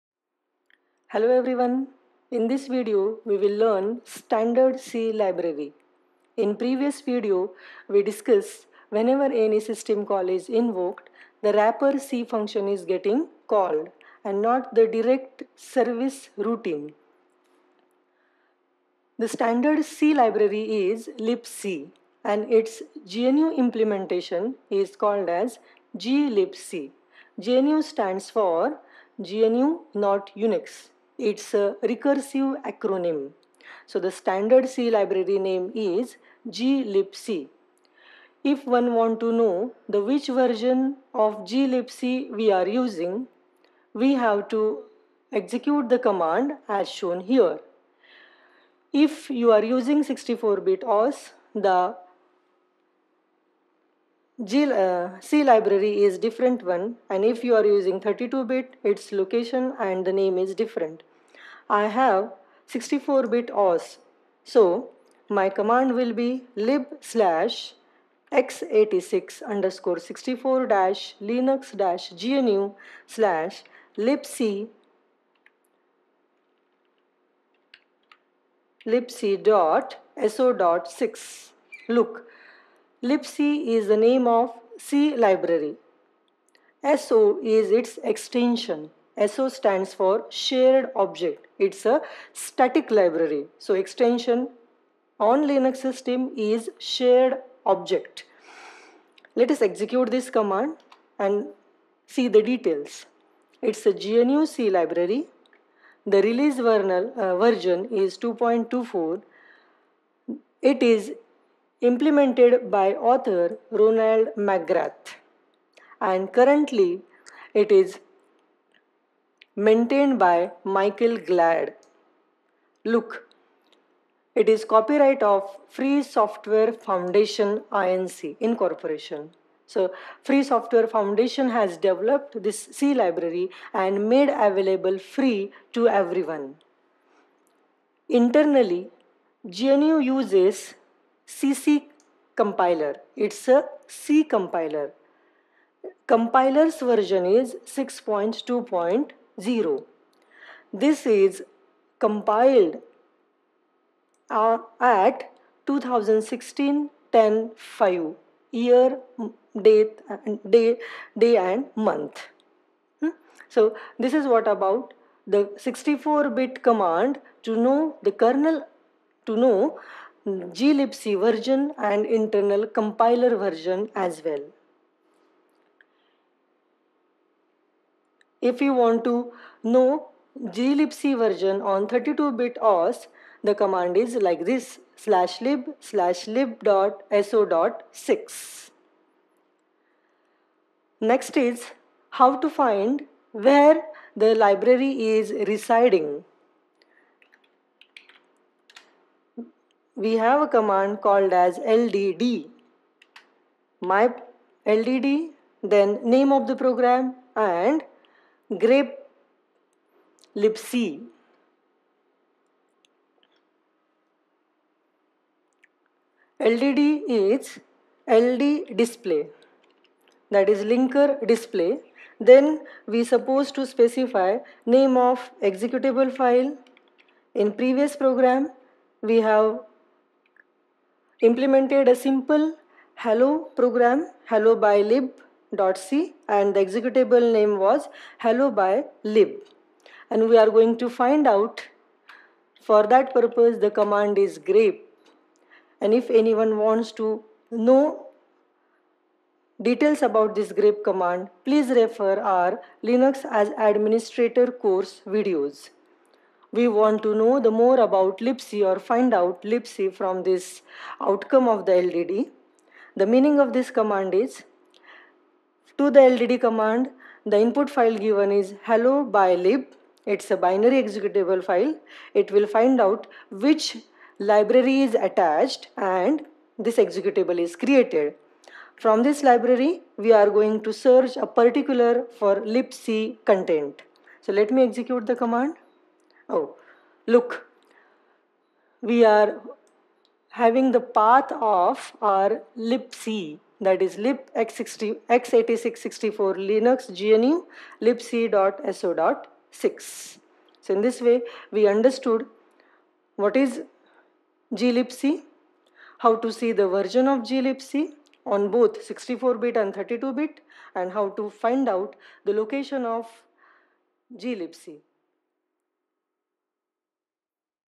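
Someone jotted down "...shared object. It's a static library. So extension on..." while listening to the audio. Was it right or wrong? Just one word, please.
right.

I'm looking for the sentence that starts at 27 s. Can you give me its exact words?
GNU stands for GNU not Unix its a recursive acronym.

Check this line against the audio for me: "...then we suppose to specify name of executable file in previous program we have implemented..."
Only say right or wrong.
right.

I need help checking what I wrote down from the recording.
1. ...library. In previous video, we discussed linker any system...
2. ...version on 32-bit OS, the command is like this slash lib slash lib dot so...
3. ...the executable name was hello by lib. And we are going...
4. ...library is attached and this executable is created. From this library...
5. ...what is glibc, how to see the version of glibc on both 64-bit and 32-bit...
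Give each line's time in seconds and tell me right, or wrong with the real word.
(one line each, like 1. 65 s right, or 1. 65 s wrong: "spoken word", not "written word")
1. 5 s wrong: "whenever", not "linker"
2. 181 s right
3. 236 s right
4. 274 s right
5. 303 s right.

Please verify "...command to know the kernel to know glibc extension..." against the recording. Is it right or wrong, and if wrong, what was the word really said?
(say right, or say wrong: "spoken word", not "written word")
wrong: "version", not "extension".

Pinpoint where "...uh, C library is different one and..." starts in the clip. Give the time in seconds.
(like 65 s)
54 s.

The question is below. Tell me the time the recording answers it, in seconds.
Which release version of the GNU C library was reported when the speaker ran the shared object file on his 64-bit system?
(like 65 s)
108 s.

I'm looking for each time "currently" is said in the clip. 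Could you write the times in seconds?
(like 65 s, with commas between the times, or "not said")
116 s.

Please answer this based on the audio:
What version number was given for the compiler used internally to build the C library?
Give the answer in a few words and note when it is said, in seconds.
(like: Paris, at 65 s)
6.2.1, at 147 s.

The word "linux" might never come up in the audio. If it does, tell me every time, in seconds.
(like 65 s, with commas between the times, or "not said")
71 s, 95 s, 252 s, 296 s.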